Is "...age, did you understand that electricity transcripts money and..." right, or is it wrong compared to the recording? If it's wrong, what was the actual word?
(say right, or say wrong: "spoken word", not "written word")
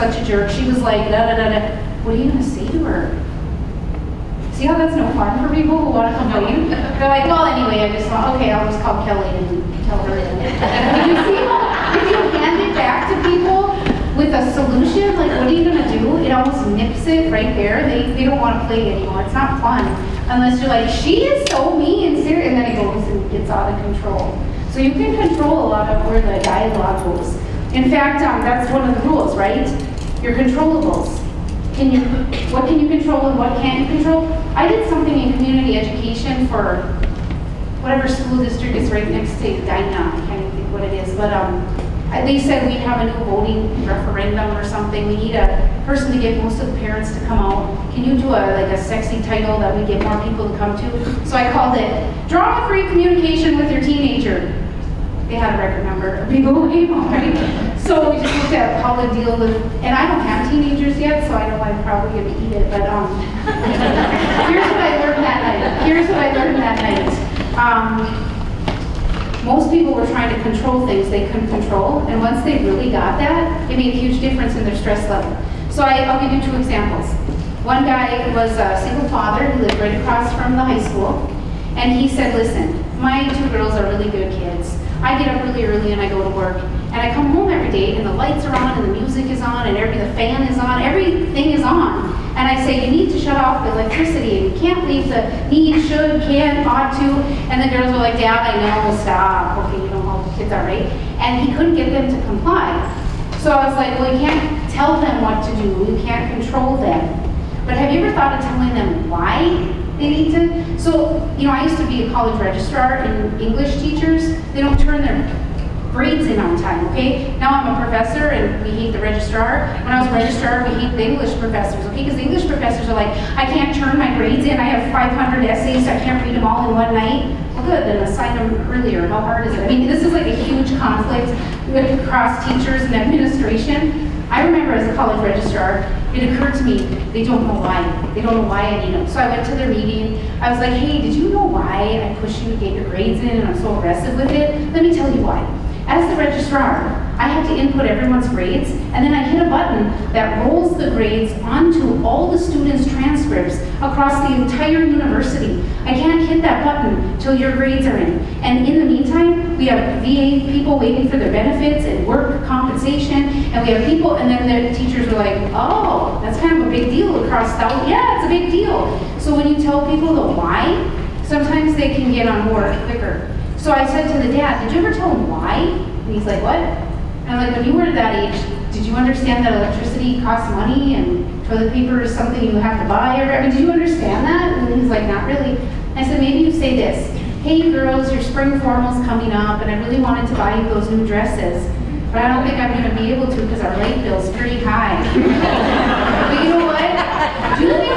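wrong: "costs", not "transcripts".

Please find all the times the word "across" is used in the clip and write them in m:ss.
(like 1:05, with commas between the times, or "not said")
1:20, 2:12, 2:33, 2:47.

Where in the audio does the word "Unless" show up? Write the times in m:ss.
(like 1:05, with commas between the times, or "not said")
0:20.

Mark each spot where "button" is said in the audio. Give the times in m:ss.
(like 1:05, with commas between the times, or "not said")
2:29, 2:36.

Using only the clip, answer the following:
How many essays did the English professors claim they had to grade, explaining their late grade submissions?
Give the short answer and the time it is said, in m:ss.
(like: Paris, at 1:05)
500, at 2:04.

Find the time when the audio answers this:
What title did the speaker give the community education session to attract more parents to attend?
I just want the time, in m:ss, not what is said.
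0:52.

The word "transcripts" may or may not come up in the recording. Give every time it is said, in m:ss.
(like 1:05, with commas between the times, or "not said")
2:32.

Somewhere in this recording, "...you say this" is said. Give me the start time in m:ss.
3:06.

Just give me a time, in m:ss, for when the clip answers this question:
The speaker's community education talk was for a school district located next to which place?
0:39.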